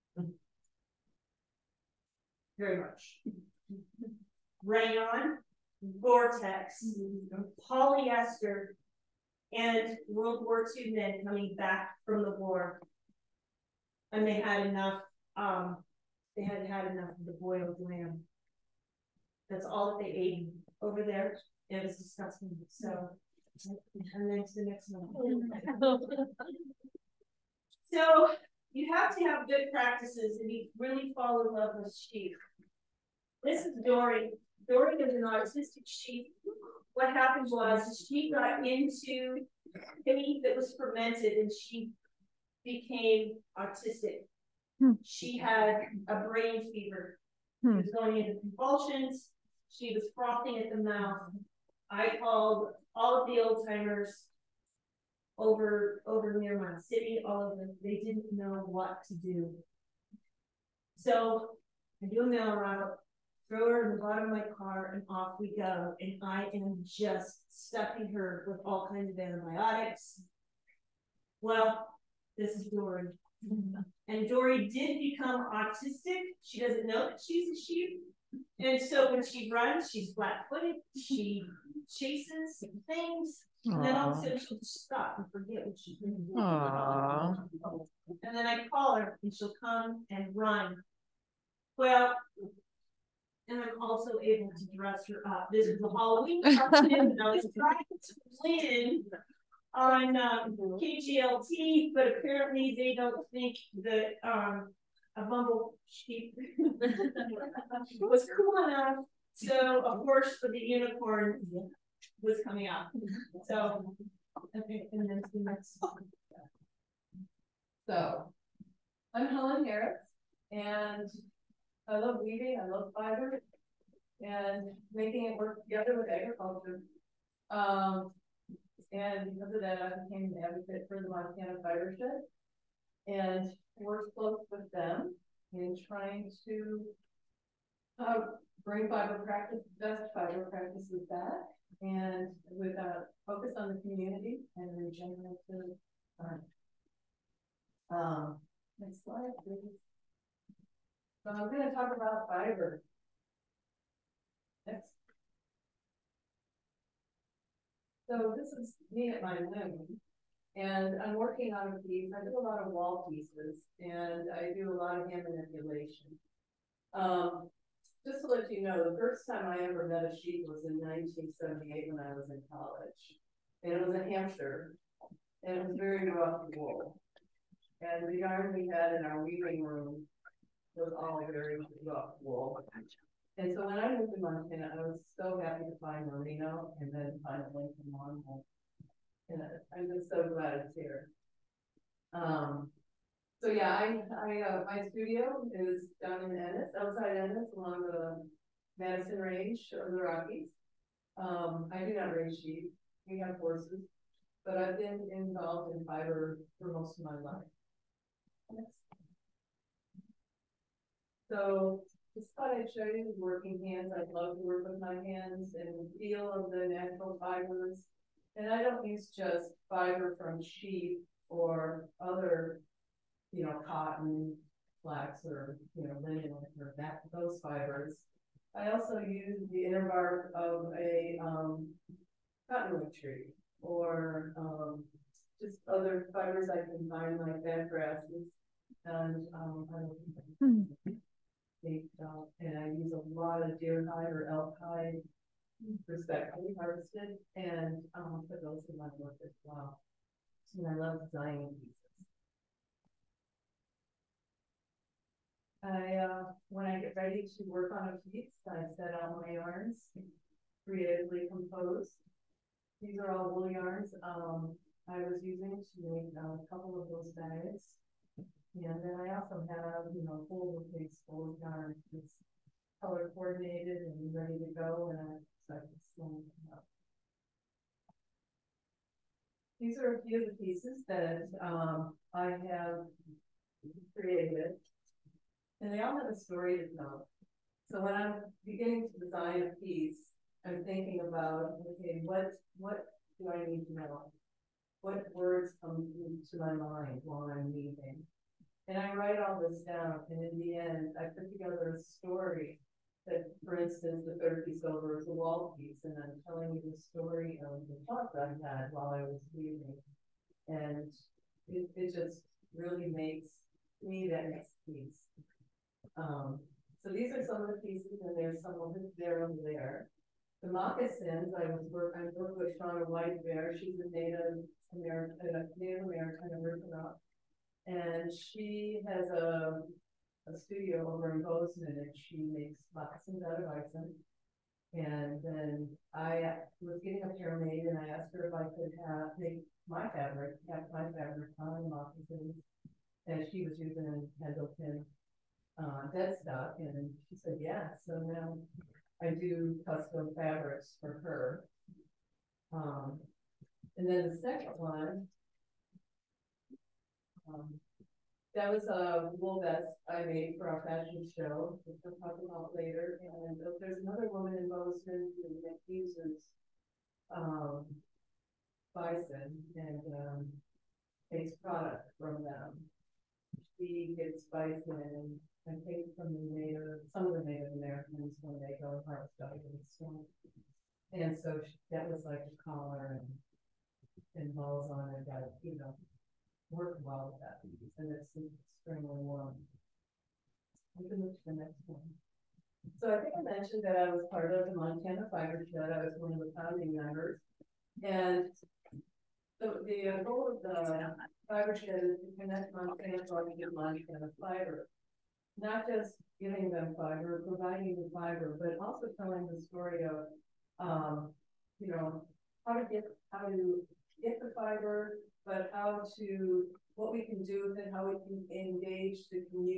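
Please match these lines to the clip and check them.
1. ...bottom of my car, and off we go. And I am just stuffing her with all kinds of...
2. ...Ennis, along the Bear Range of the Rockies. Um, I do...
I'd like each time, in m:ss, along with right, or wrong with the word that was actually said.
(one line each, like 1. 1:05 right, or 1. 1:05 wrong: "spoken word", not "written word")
1. 1:04 right
2. 3:17 wrong: "Madison", not "Bear".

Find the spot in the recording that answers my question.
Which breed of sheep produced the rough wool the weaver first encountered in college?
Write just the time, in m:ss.
2:54.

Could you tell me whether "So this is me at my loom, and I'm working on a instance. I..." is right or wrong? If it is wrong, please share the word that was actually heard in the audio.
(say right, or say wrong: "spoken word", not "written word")
wrong: "piece", not "instance".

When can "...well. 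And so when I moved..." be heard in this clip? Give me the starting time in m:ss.
3:01.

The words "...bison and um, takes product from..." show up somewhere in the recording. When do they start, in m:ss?
6:08.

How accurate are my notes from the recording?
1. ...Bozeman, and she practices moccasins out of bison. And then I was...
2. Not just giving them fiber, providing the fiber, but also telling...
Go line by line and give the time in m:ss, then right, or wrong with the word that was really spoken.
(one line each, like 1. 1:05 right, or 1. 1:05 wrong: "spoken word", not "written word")
1. 5:31 wrong: "makes", not "practices"
2. 6:45 right.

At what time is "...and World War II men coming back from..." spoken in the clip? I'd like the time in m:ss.
0:09.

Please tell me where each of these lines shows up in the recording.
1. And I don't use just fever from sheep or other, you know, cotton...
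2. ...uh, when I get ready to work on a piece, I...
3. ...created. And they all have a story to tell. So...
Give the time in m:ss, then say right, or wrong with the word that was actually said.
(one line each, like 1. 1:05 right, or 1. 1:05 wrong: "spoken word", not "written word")
1. 3:38 wrong: "fiber", not "fever"
2. 4:15 right
3. 4:43 right.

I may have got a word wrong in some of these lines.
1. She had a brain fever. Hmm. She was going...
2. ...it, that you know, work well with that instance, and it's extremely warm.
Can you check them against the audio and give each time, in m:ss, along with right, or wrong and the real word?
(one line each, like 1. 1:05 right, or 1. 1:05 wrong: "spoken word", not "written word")
1. 0:45 right
2. 6:24 wrong: "piece", not "instance".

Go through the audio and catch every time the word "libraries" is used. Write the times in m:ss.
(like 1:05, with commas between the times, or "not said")
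not said.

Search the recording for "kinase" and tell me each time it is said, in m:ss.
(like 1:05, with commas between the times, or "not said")
not said.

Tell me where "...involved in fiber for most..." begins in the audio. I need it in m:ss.
3:25.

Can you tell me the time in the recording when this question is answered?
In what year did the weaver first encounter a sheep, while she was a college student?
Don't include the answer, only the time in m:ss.
2:50.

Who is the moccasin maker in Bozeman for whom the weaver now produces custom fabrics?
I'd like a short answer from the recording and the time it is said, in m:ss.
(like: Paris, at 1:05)
Shauna White Bear, at 5:22.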